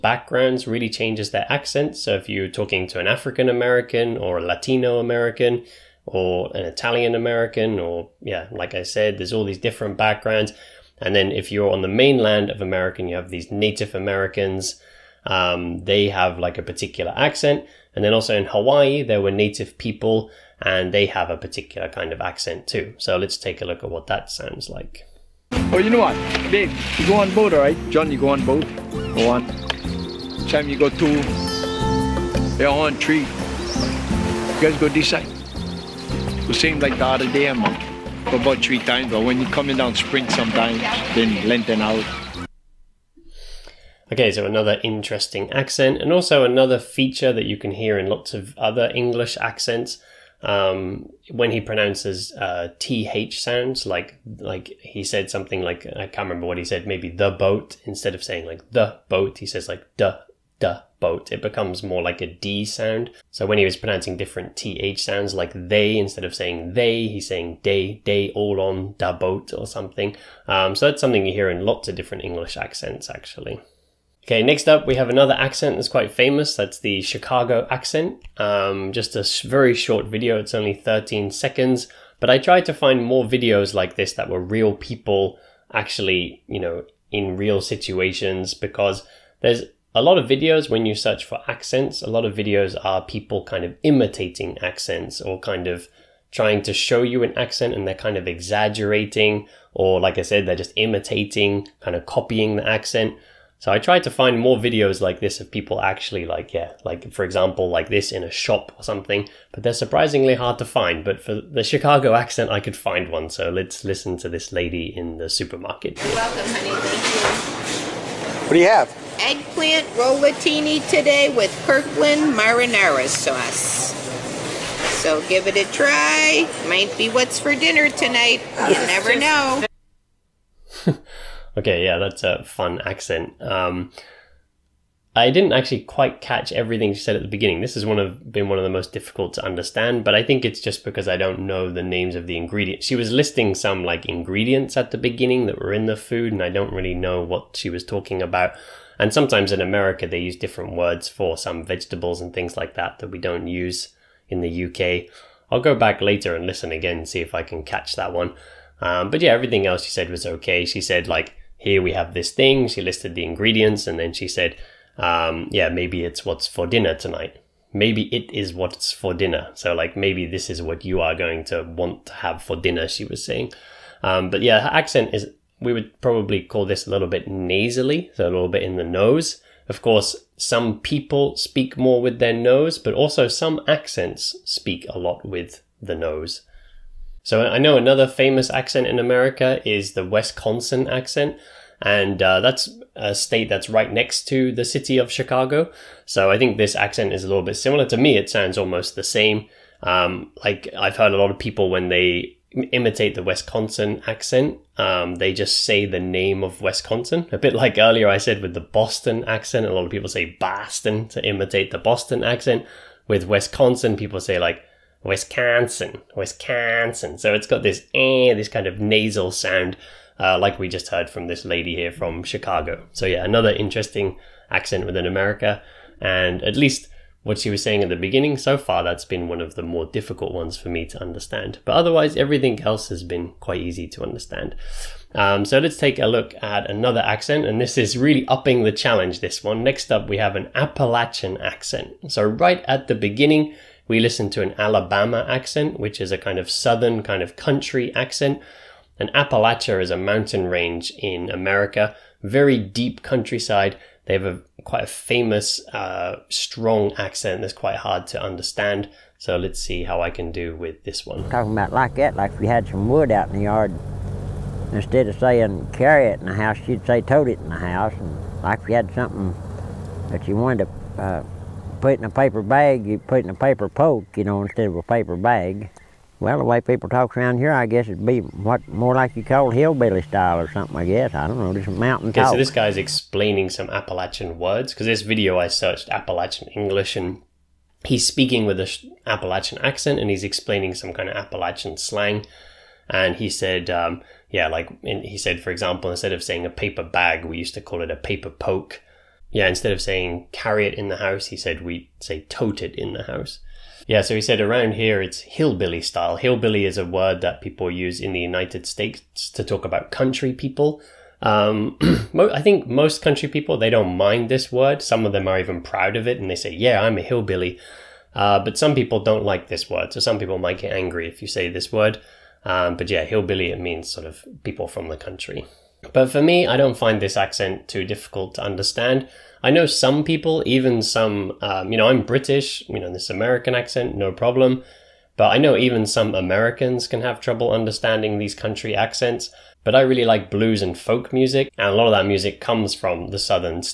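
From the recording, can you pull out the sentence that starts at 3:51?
But otherwise, everything else has been quite easy to understand.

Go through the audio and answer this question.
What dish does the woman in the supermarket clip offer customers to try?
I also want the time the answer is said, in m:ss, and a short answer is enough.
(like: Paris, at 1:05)
Eggplant rollatini, at 1:59.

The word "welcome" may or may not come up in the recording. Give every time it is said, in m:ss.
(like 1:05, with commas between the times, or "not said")
1:56.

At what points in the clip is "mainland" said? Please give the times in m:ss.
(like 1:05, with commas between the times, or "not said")
0:11.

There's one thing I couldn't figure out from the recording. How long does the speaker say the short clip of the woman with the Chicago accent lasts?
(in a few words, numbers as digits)
13 seconds.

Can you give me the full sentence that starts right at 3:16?
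So I think this accent is a little bit similar.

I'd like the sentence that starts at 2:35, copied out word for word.
I'll go back later and listen again and see if I can catch that one.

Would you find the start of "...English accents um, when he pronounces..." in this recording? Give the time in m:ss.
0:48.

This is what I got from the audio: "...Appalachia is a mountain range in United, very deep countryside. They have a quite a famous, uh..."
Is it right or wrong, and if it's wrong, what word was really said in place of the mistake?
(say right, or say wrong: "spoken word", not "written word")
wrong: "America", not "United".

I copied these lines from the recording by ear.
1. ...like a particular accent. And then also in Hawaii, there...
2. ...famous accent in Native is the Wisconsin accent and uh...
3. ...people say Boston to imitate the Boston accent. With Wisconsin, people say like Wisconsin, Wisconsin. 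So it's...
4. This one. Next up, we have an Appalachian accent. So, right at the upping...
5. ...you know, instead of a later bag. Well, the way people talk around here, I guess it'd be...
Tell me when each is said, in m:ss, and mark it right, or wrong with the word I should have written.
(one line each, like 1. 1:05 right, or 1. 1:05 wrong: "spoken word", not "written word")
1. 0:16 right
2. 3:08 wrong: "America", not "Native"
3. 3:29 right
4. 3:59 wrong: "beginning", not "upping"
5. 4:34 wrong: "paper", not "later".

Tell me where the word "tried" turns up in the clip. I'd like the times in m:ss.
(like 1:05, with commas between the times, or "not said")
1:22, 1:43.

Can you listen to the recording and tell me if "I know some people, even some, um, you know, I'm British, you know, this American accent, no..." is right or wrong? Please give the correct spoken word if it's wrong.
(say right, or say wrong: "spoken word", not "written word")
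right.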